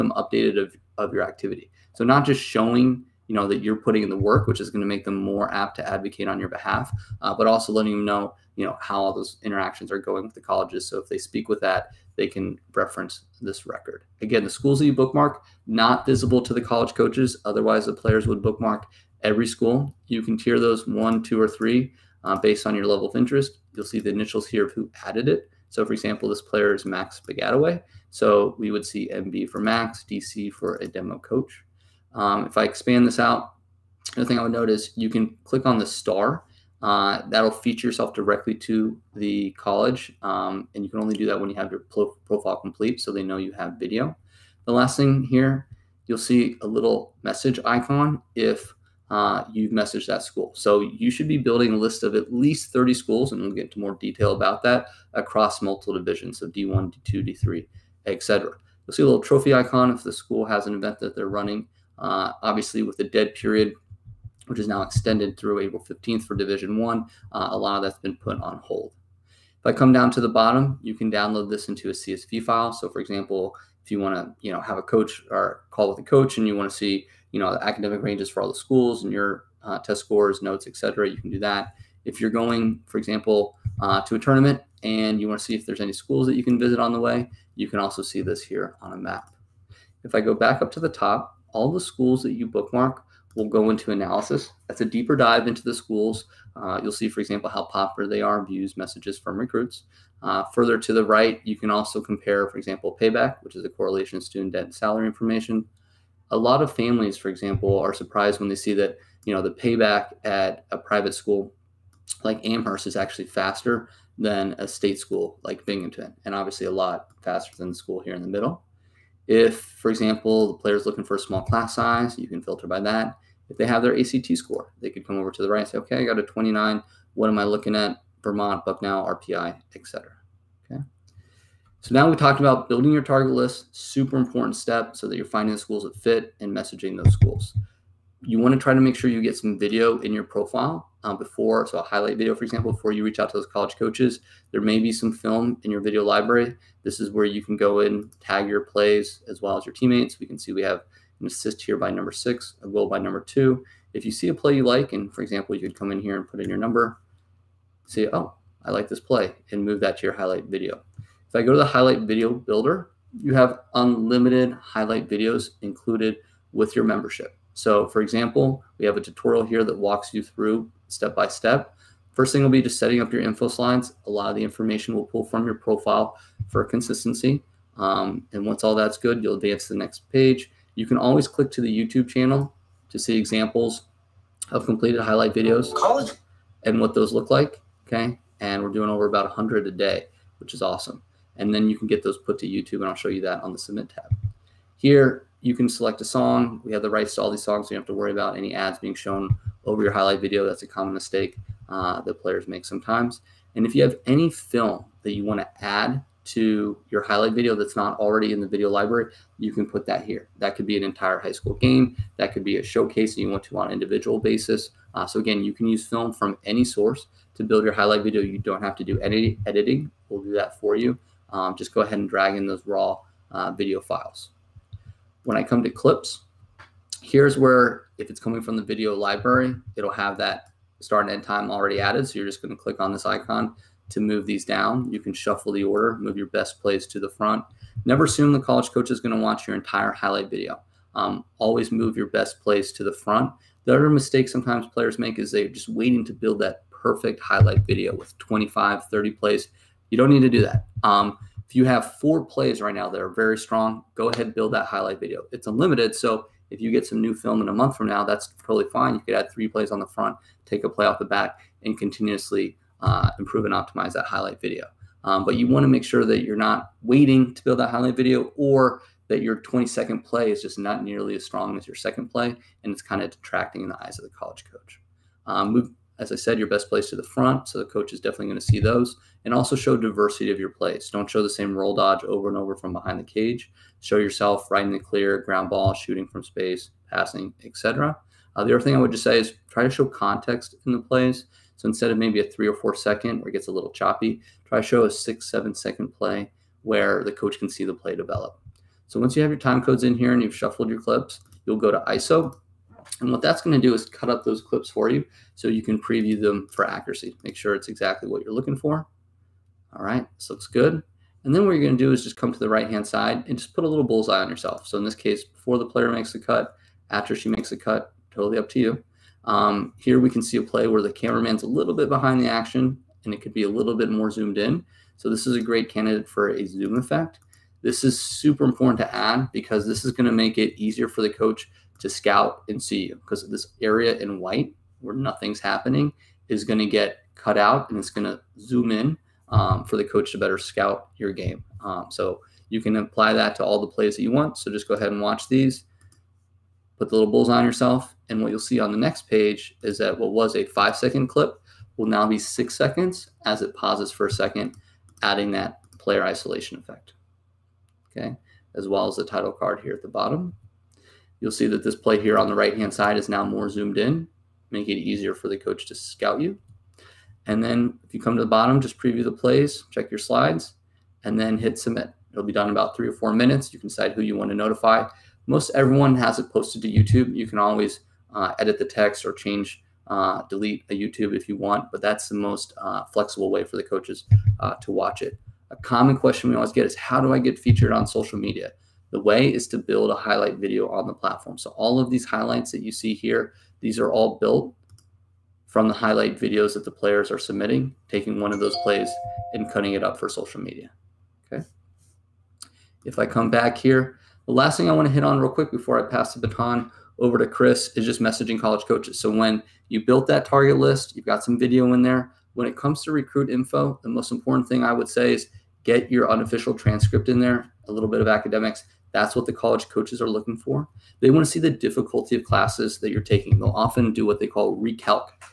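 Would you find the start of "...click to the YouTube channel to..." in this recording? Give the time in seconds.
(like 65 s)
181 s.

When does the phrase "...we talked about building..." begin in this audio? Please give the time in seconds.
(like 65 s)
132 s.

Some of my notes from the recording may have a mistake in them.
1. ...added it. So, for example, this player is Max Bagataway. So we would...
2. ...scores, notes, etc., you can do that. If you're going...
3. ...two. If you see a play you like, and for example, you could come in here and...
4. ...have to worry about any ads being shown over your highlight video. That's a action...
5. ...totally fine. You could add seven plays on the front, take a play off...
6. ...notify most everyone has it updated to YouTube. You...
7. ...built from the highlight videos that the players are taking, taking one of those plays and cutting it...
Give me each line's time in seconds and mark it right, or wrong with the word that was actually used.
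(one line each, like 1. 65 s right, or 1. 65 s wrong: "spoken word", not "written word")
1. 25 s right
2. 80 s right
3. 153 s right
4. 197 s wrong: "common", not "action"
5. 258 s wrong: "three", not "seven"
6. 374 s wrong: "posted", not "updated"
7. 394 s wrong: "submitting", not "taking".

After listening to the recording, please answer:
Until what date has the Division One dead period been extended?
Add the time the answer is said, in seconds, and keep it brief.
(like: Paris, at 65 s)
April 15th, at 65 s.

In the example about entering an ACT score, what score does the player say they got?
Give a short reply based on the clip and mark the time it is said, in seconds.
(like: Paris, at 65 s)
29, at 126 s.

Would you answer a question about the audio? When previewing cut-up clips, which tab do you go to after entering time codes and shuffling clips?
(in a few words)
ISO.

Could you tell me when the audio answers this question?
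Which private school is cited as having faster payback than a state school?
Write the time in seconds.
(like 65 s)
112 s.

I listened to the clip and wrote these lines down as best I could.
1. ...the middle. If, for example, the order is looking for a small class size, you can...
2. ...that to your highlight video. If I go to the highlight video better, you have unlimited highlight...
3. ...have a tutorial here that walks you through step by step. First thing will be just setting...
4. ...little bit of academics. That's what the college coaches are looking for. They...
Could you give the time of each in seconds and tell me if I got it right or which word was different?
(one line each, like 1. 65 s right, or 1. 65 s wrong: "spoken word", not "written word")
1. 118 s wrong: "player", not "order"
2. 159 s wrong: "builder", not "better"
3. 168 s right
4. 417 s right.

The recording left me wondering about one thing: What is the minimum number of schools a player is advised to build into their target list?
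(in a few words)
30.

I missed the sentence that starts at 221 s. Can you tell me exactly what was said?
Um, just go ahead and drag in those raw uh, video files.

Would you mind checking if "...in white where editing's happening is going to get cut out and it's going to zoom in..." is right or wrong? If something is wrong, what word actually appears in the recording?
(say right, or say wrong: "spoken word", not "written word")
wrong: "nothing", not "editing".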